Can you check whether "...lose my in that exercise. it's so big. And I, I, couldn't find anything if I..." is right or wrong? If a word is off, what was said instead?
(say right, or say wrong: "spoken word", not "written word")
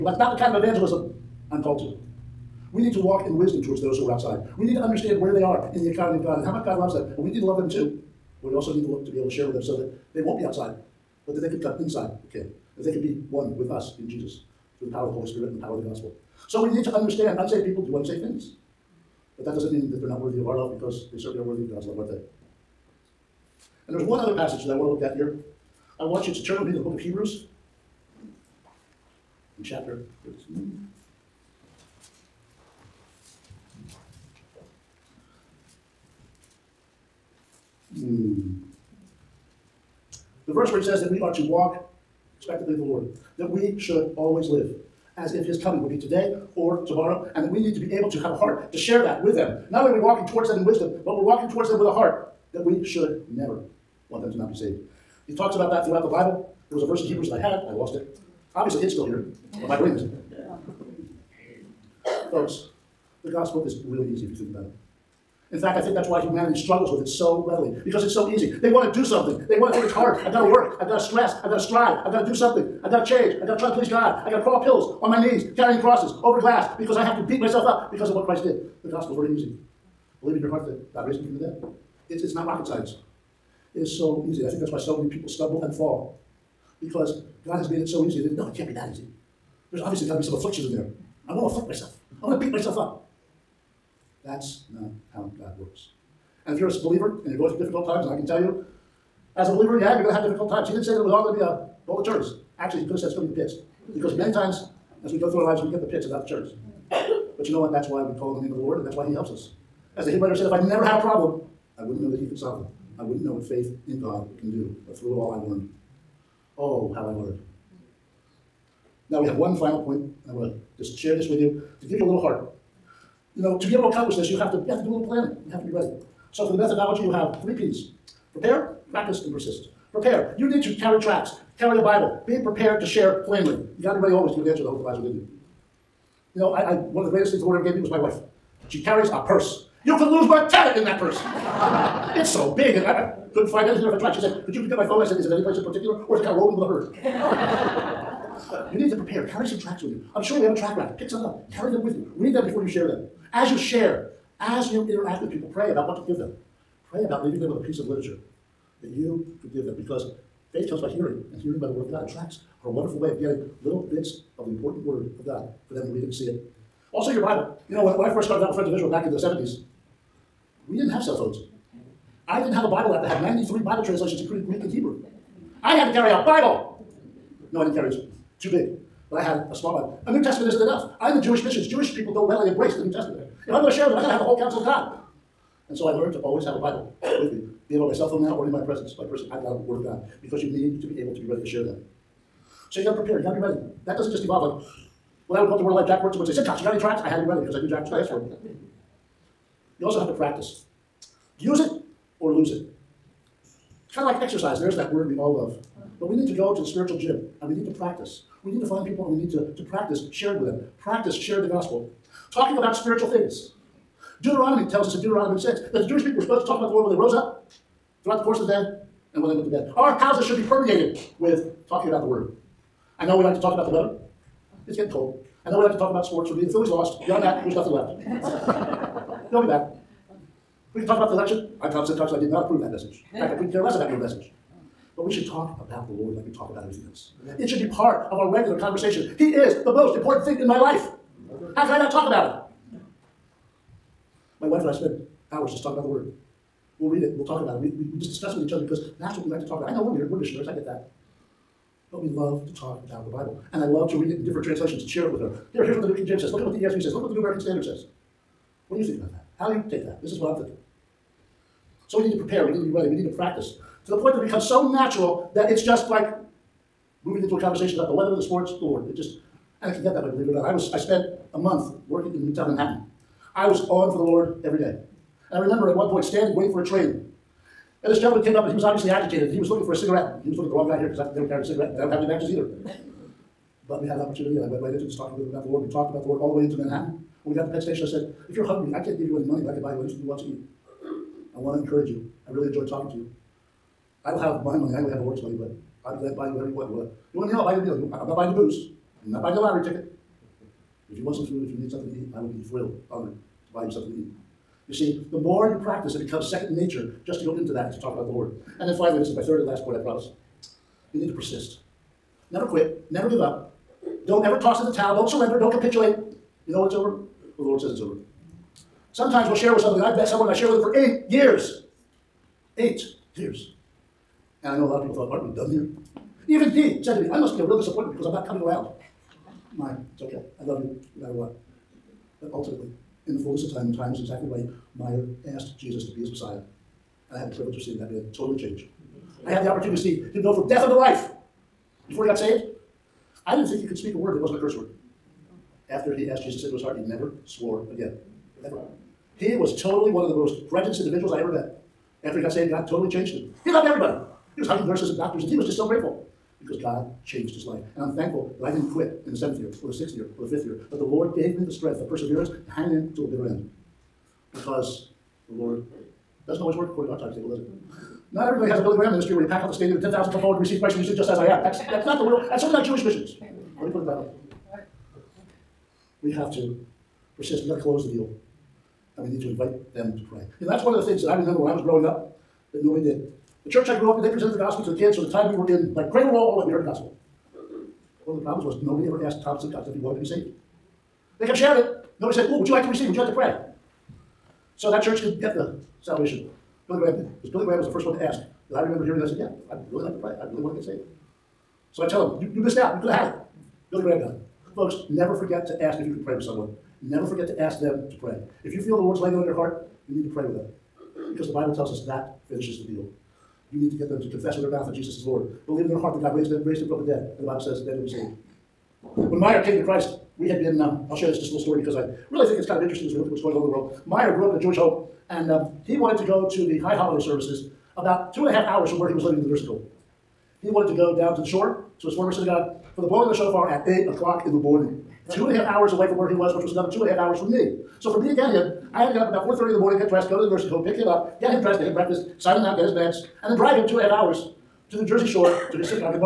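wrong: "purse", not "exercise".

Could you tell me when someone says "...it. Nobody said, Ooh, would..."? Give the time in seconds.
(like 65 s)
391 s.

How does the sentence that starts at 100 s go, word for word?
He didn't say that it was all going to be a bowl of cherries.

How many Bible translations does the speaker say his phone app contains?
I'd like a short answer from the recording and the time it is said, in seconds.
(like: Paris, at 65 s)
93, at 173 s.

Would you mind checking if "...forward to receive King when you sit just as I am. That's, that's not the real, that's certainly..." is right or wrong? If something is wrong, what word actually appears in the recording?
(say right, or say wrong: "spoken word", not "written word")
wrong: "Christ", not "King".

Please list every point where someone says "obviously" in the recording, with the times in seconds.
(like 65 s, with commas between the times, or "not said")
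58 s, 89 s, 278 s.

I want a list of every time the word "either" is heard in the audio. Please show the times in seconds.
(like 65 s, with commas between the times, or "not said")
282 s.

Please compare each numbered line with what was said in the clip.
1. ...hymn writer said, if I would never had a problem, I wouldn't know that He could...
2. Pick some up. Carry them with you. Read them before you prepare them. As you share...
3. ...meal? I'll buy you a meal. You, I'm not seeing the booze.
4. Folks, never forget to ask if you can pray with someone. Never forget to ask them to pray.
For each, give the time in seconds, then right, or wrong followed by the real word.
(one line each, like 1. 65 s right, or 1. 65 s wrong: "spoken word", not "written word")
1. 110 s right
2. 150 s wrong: "share", not "prepare"
3. 297 s wrong: "buying", not "seeing"
4. 404 s right.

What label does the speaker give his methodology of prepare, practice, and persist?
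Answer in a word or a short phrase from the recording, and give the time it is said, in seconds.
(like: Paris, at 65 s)
three Ps, at 127 s.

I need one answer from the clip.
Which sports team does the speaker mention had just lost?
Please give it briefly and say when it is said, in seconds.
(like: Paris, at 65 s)
the Phillies, at 226 s.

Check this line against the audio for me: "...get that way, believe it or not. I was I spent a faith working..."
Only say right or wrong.
wrong.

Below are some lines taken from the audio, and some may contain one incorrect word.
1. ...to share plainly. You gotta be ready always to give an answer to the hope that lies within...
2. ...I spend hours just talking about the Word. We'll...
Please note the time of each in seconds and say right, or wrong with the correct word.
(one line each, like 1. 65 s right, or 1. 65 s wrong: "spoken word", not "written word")
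1. 132 s right
2. 244 s right.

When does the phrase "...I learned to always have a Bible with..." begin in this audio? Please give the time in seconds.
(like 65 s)
185 s.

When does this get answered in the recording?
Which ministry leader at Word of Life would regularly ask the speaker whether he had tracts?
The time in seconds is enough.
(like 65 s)
195 s.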